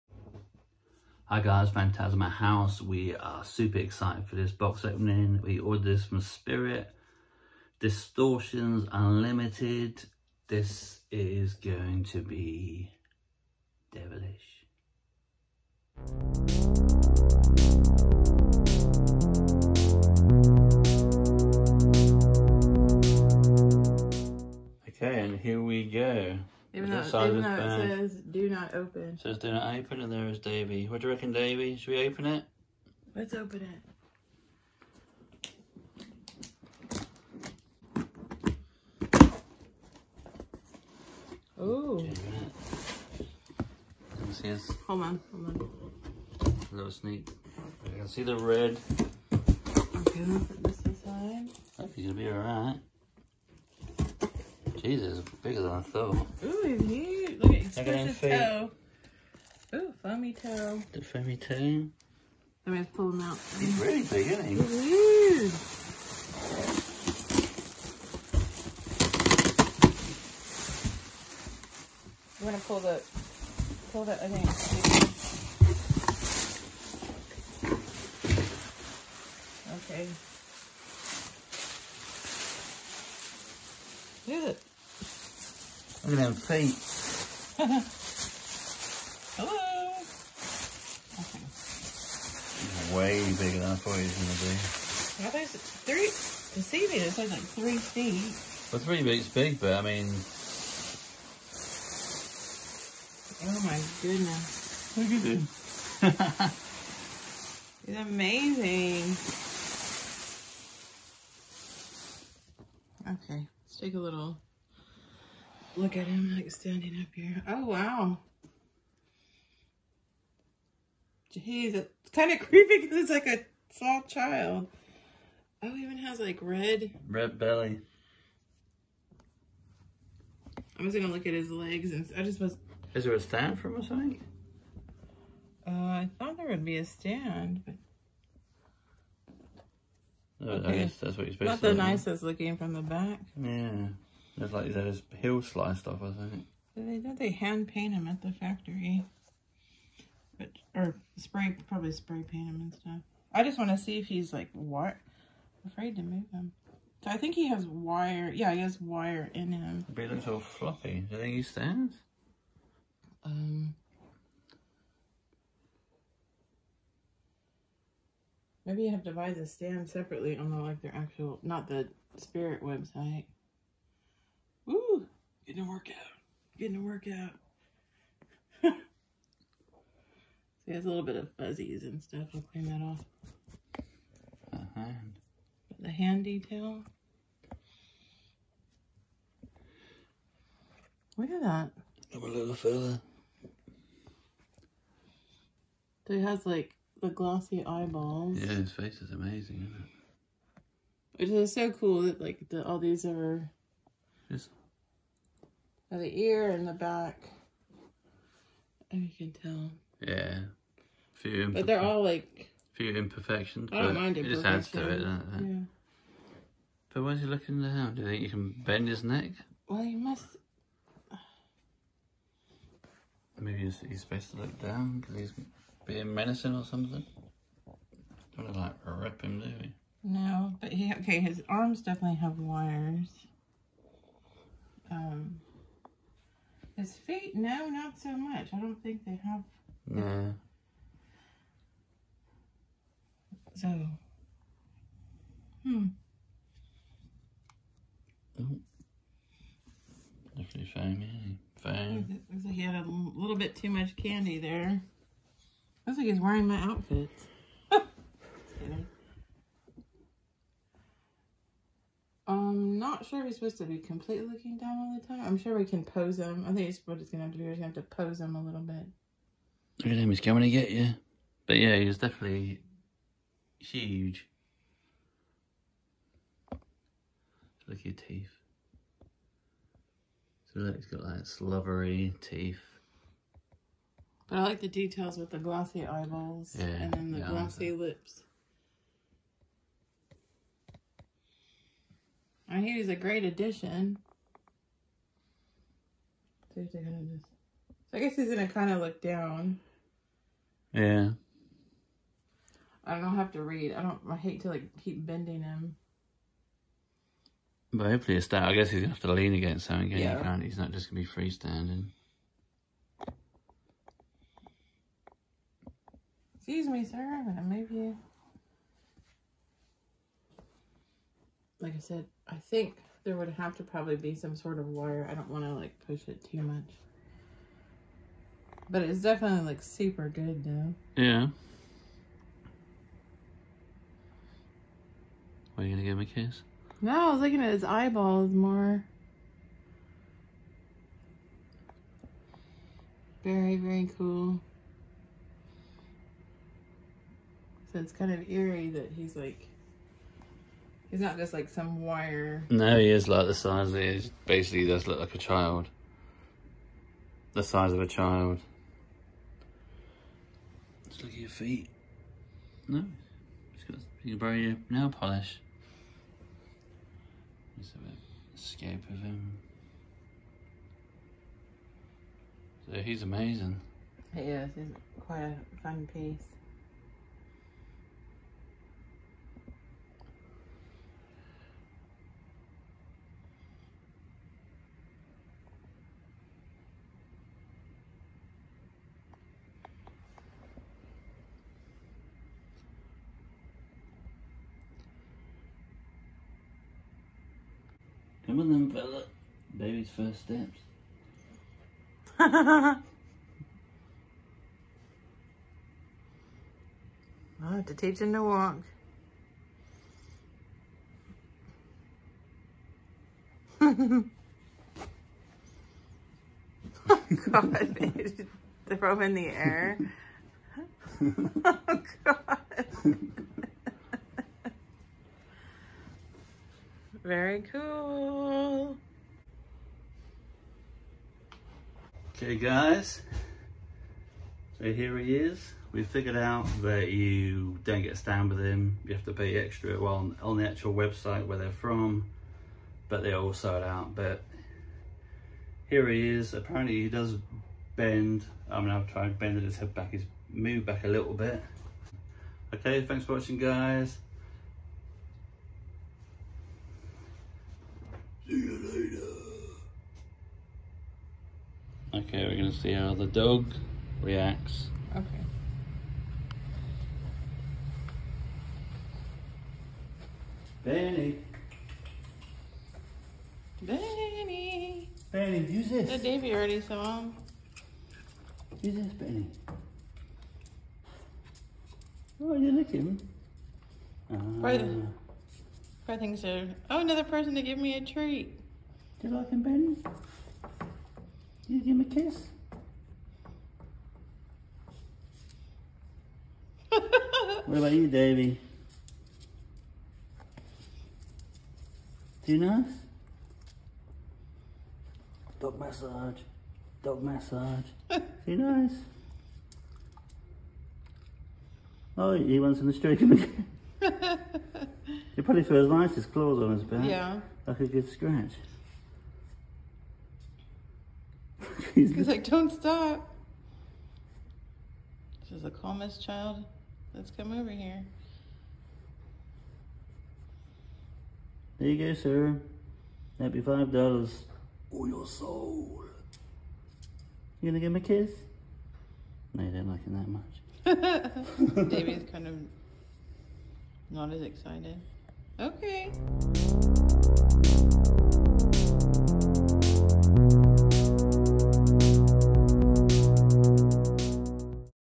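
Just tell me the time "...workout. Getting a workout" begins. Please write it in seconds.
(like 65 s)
175 s.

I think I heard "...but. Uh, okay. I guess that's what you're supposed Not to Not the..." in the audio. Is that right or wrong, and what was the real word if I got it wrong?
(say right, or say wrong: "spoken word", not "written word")
right.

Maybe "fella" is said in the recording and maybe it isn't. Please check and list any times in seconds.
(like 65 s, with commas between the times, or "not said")
192 s, 398 s.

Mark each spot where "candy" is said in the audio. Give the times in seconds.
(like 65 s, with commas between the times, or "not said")
253 s.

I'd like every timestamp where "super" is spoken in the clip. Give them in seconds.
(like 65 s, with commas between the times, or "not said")
3 s, 329 s.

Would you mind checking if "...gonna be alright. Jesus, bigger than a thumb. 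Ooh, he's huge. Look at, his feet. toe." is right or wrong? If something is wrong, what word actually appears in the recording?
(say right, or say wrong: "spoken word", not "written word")
right.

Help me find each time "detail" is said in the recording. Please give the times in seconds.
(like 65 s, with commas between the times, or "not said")
186 s, 284 s.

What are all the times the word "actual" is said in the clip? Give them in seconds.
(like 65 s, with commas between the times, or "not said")
170 s, 440 s.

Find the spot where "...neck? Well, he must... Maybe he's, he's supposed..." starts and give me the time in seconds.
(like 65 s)
219 s.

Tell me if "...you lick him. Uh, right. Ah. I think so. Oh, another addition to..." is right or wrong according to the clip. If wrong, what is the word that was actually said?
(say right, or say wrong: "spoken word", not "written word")
wrong: "person", not "addition".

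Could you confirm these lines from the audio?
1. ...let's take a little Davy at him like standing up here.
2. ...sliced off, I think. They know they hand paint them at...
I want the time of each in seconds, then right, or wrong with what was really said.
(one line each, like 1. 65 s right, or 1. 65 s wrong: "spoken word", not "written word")
1. 113 s wrong: "Look", not "Davy"
2. 145 s right.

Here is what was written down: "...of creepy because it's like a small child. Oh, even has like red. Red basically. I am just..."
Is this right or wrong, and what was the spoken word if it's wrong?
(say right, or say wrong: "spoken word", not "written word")
wrong: "belly", not "basically".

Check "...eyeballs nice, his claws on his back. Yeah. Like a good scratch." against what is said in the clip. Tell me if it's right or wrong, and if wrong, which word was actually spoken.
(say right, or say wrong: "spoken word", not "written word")
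wrong: "feels", not "eyeballs".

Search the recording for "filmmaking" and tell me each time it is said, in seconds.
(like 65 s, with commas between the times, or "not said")
not said.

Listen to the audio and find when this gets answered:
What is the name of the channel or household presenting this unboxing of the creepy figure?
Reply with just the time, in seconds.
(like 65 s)
1 s.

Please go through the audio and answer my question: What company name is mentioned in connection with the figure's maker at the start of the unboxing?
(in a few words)
Distortions Unlimited.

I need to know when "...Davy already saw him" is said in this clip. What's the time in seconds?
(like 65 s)
475 s.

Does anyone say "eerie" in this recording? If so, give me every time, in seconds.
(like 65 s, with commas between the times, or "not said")
348 s.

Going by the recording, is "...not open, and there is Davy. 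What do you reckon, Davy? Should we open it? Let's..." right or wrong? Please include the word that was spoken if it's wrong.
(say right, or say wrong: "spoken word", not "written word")
right.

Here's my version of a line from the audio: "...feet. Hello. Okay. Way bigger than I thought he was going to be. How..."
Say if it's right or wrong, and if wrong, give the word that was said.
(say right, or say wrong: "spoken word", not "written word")
right.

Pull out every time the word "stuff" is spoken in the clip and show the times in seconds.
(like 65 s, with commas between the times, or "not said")
152 s, 182 s.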